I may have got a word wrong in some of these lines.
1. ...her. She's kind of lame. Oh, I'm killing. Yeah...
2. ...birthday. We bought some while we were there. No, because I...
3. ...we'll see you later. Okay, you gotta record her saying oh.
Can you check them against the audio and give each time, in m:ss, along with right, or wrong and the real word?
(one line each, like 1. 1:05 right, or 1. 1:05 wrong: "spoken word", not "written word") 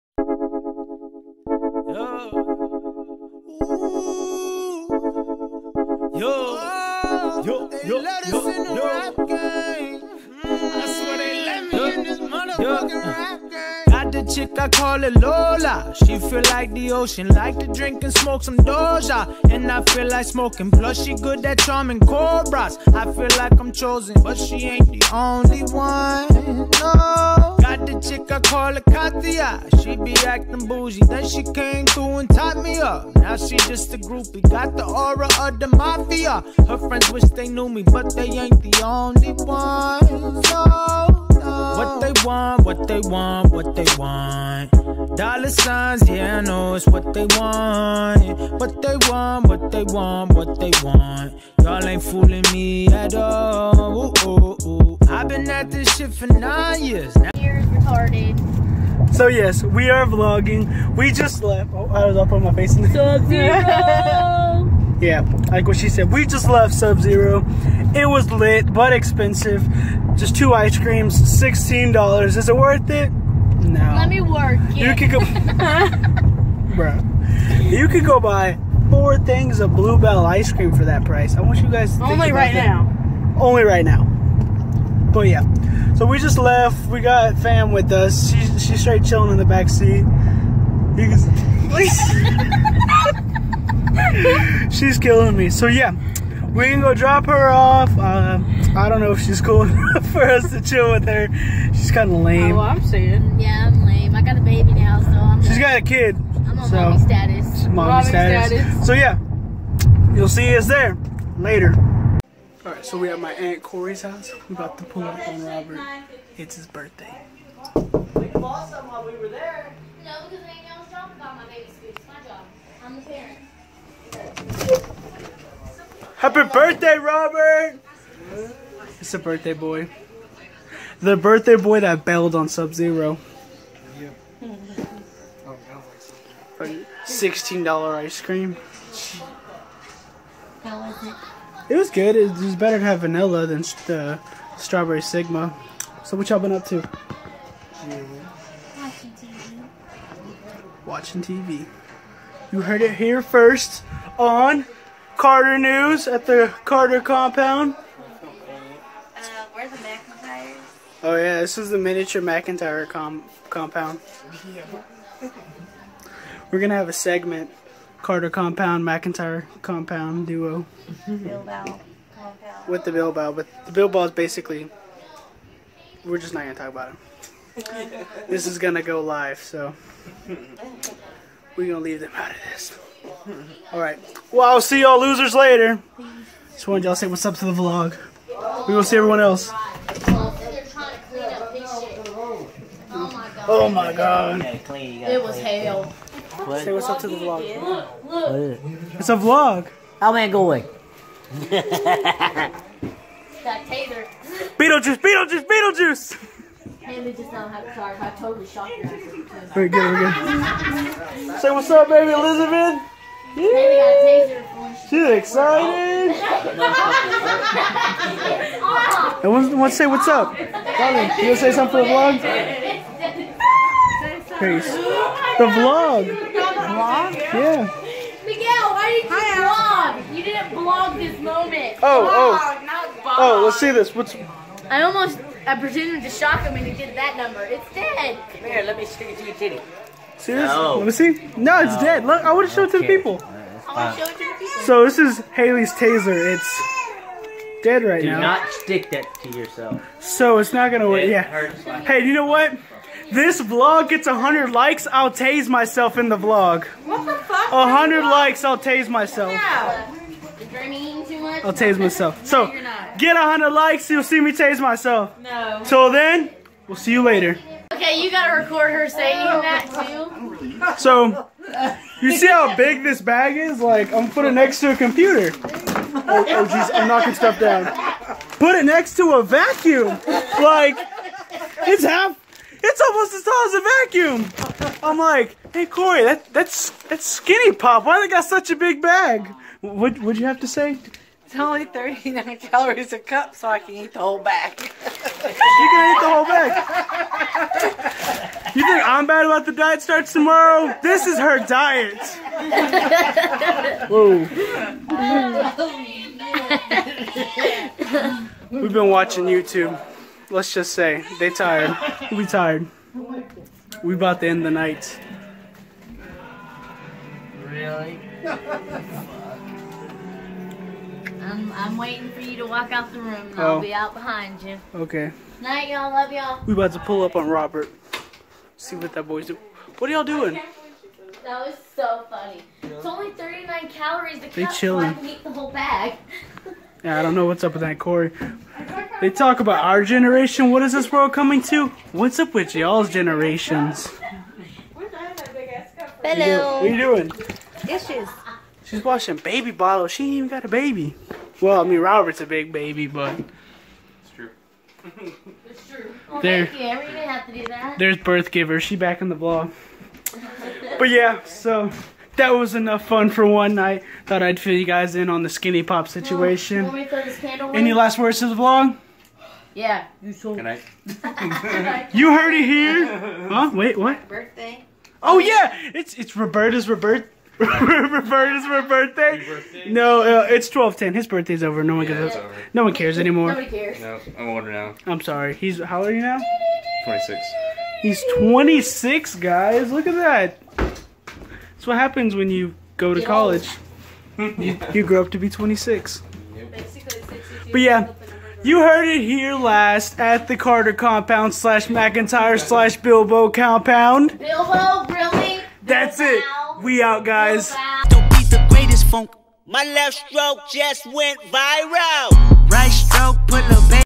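1. 1:41 wrong: "saying", not "killing"
2. 1:56 right
3. 4:26 right.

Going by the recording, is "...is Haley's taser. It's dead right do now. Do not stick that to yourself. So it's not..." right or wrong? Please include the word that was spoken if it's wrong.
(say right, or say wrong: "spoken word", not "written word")
right.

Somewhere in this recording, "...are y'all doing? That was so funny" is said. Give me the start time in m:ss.
5:29.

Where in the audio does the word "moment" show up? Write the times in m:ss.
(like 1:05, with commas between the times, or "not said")
3:51.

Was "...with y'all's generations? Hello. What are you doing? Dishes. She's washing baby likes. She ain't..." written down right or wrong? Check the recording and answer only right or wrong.
wrong.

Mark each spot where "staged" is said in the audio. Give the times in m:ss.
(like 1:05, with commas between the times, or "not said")
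not said.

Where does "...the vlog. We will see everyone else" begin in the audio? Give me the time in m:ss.
3:07.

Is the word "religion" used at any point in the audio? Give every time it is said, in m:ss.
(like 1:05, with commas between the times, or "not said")
not said.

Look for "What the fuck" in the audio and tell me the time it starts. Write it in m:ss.
4:16.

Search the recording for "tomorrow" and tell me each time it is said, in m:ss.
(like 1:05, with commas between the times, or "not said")
5:00.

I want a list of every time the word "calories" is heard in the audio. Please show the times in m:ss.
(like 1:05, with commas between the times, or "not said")
4:52, 5:33.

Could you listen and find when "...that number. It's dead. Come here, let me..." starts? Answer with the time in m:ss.
3:56.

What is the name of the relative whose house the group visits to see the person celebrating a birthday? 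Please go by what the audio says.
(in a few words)
Aunt Corey.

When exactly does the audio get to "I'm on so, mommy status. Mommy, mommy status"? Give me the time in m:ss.
1:46.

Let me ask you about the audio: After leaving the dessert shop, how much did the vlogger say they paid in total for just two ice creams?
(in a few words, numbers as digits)
$16.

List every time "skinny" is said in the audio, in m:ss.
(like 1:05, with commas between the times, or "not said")
4:47, 6:05.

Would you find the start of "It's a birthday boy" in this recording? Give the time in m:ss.
2:08.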